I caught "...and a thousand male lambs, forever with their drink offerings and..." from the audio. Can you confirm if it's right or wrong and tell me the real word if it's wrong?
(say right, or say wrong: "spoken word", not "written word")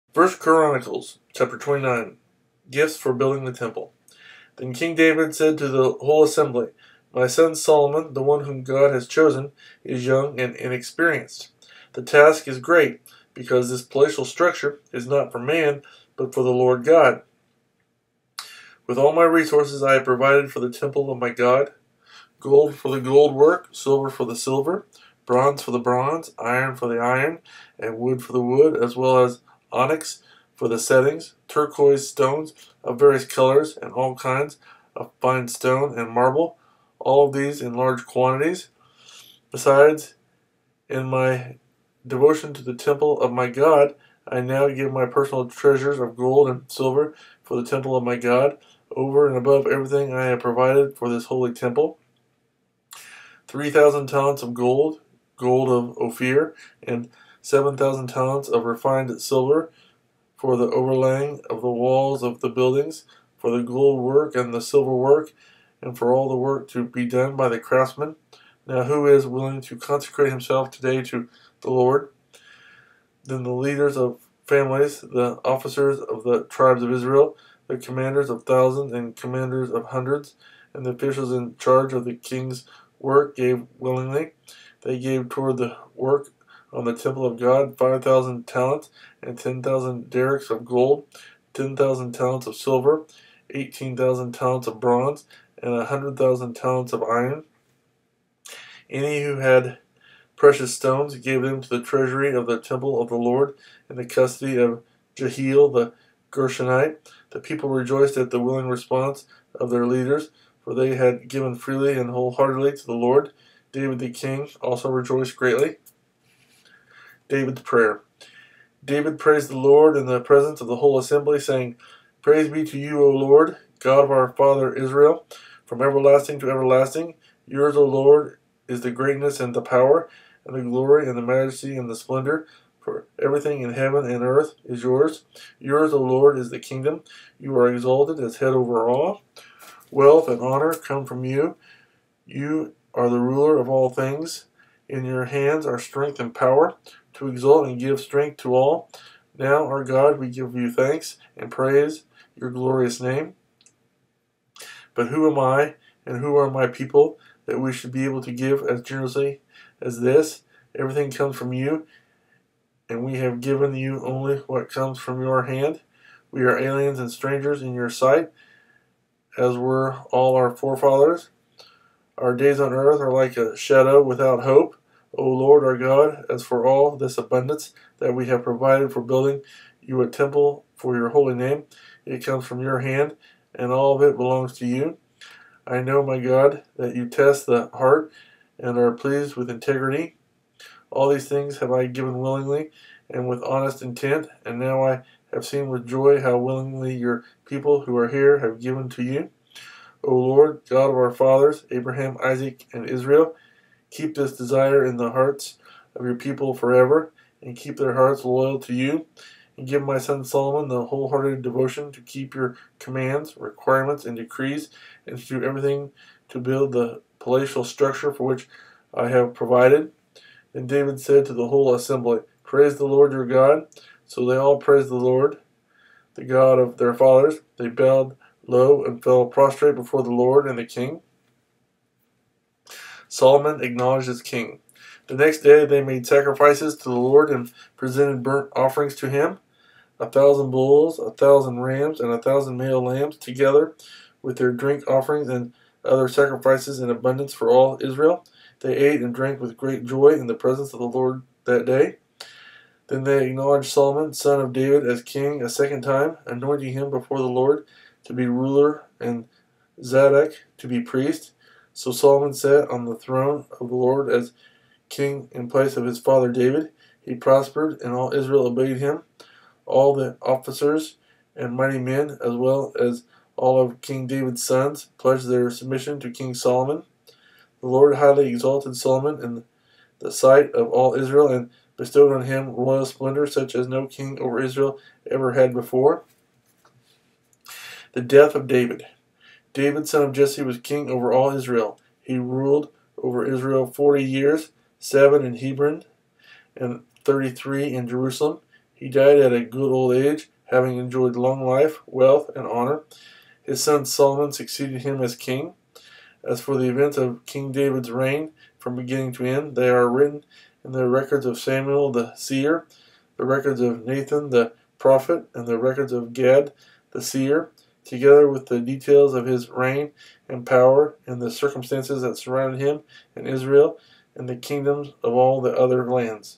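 wrong: "together", not "forever".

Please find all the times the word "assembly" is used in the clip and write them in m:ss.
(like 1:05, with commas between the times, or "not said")
0:06, 2:00, 3:41.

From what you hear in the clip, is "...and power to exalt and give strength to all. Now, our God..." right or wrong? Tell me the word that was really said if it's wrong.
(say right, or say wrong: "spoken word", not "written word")
right.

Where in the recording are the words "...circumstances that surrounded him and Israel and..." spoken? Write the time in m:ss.
5:21.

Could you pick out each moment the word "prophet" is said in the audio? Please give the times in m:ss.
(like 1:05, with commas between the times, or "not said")
5:14.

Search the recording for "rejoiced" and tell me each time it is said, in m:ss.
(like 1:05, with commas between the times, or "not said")
1:47, 1:54.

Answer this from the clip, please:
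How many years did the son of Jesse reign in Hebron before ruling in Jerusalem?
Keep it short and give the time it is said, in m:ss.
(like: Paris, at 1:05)
7, at 4:54.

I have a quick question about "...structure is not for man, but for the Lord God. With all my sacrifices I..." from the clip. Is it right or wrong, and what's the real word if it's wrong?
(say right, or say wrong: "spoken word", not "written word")
wrong: "resources", not "sacrifices".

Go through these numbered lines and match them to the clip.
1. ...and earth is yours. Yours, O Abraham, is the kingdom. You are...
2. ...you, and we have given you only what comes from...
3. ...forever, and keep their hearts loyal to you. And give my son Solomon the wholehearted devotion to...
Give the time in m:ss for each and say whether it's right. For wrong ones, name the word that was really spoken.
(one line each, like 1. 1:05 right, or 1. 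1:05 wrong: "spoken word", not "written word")
1. 2:14 wrong: "Lord", not "Abraham"
2. 2:41 right
3. 3:26 right.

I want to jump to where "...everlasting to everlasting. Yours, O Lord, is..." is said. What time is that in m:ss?
2:05.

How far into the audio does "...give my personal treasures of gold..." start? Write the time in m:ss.
0:44.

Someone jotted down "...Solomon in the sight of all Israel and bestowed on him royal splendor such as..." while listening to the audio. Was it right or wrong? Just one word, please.
right.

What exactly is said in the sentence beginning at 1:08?
Now, who is willing to consecrate himself today to the Lord?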